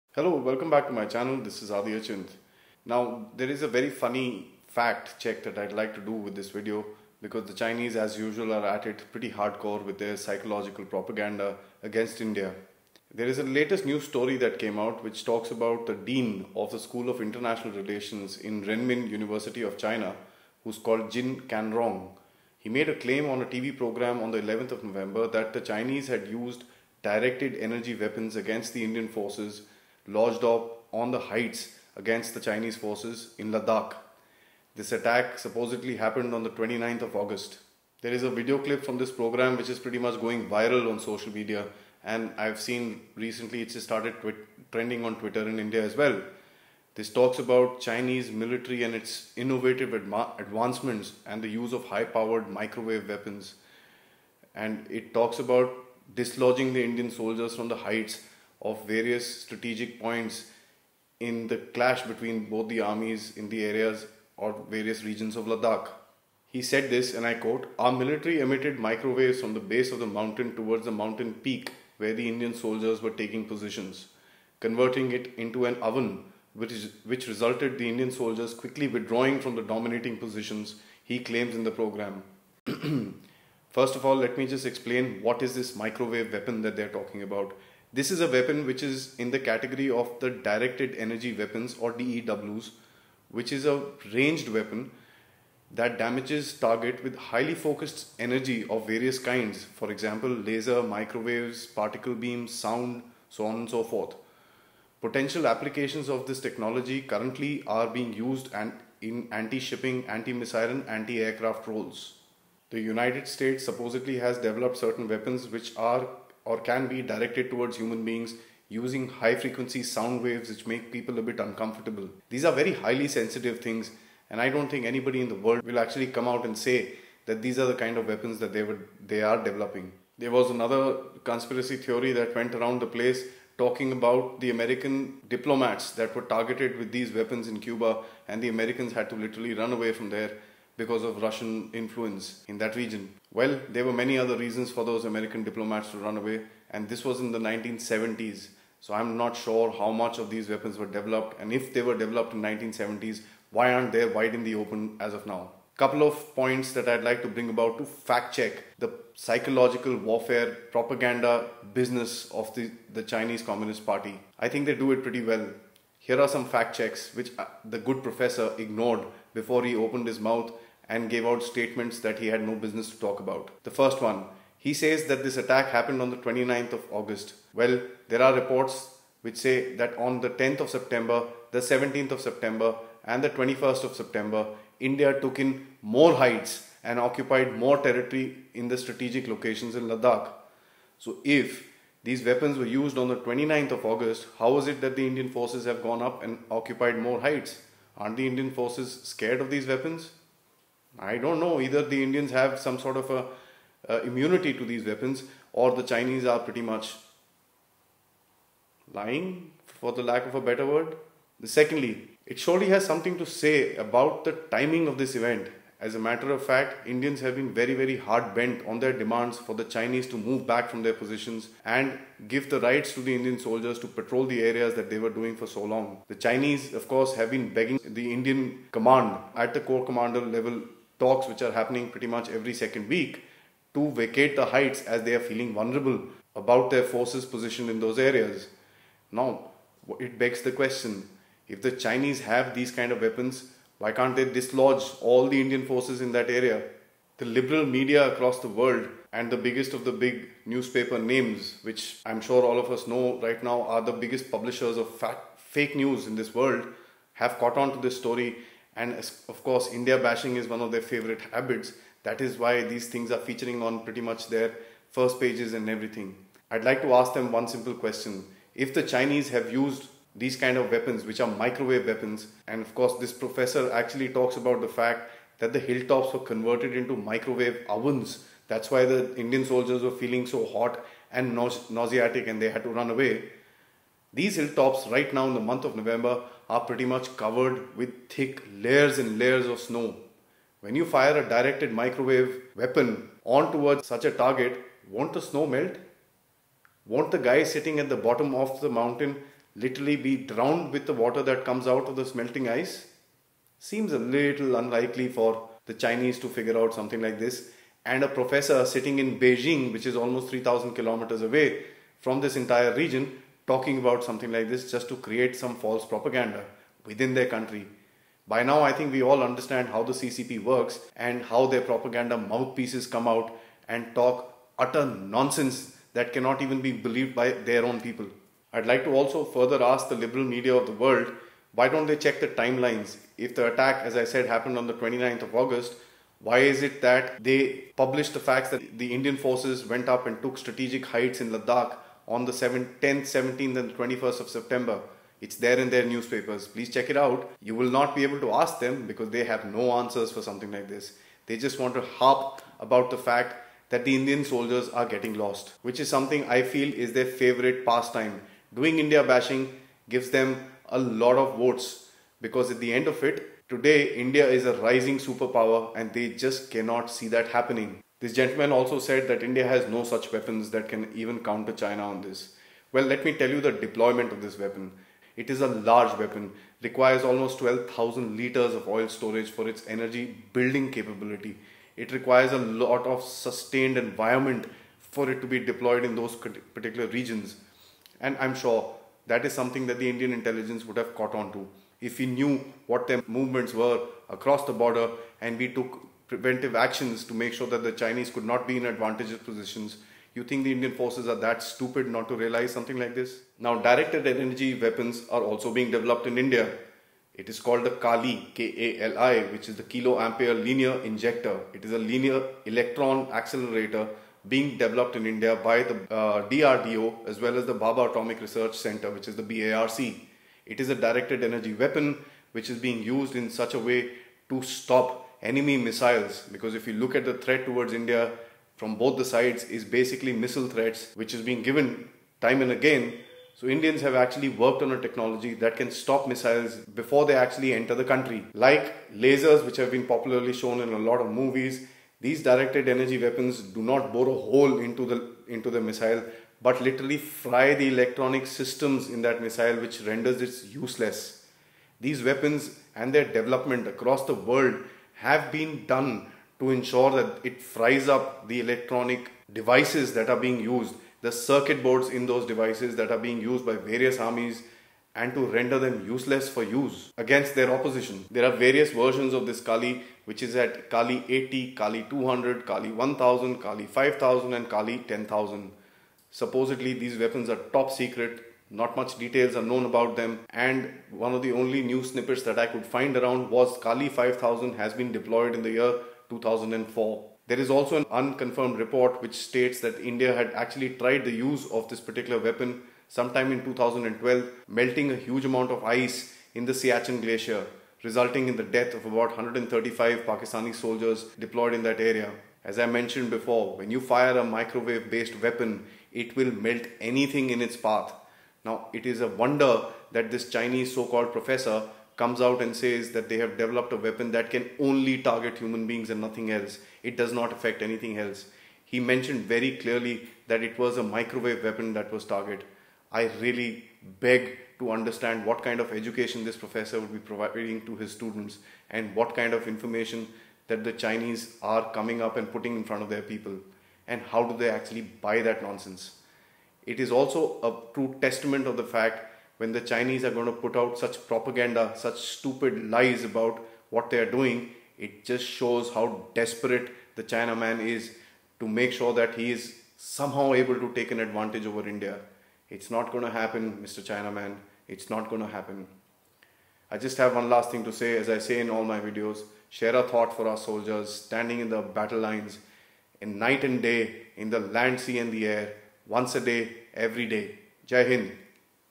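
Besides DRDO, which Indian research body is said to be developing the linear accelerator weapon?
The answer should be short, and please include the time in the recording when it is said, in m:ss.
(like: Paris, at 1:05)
Bhabha Atomic Research Center, at 6:57.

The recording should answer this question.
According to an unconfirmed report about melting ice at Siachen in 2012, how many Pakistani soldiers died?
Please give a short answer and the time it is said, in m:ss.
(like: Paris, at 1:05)
135, at 8:19.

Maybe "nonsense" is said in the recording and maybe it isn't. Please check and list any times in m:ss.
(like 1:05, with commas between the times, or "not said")
5:24, 8:55.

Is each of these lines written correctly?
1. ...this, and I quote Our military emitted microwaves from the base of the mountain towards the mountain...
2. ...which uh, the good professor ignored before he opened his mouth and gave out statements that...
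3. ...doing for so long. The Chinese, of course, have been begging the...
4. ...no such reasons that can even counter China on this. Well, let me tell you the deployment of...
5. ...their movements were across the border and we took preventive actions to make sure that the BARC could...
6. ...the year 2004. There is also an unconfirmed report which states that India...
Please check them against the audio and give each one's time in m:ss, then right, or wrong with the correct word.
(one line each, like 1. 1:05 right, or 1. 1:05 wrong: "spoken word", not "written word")
1. 1:06 right
2. 2:47 right
3. 3:45 right
4. 6:09 wrong: "weapons", not "reasons"
5. 6:32 wrong: "Chinese", not "BARC"
6. 8:05 right.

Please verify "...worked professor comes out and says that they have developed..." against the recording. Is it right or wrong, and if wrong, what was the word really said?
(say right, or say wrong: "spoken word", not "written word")
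wrong: "called", not "worked".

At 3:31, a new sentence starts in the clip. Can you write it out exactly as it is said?
Secondly, it surely has something to say about the timing of this event.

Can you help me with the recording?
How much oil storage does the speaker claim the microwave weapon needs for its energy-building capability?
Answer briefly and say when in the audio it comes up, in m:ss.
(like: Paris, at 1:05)
12,000 liters, at 6:17.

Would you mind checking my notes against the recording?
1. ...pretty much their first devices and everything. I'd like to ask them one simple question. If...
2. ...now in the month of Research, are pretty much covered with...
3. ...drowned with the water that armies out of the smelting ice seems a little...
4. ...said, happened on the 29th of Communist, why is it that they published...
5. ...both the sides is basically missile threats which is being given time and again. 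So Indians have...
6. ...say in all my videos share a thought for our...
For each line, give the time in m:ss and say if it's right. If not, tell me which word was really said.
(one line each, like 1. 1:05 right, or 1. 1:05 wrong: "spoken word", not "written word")
1. 4:23 wrong: "pages", not "devices"
2. 4:45 wrong: "November", not "Research"
3. 5:00 wrong: "comes", not "armies"
4. 5:34 wrong: "August", not "Communist"
5. 7:08 right
6. 9:18 right.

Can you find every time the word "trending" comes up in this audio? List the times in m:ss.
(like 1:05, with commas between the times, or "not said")
0:44.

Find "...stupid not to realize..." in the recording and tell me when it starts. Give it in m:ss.
6:41.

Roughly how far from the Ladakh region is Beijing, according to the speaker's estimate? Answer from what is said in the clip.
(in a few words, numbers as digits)
3,000 kilometers.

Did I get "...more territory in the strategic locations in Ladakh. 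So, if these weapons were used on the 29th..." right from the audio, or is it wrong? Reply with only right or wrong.
right.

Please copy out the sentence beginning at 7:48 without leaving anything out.
There are various versions of this Kali which is at Kali 80, Kali 200, Kali 1000, Kali 5000 and Kali 10,000.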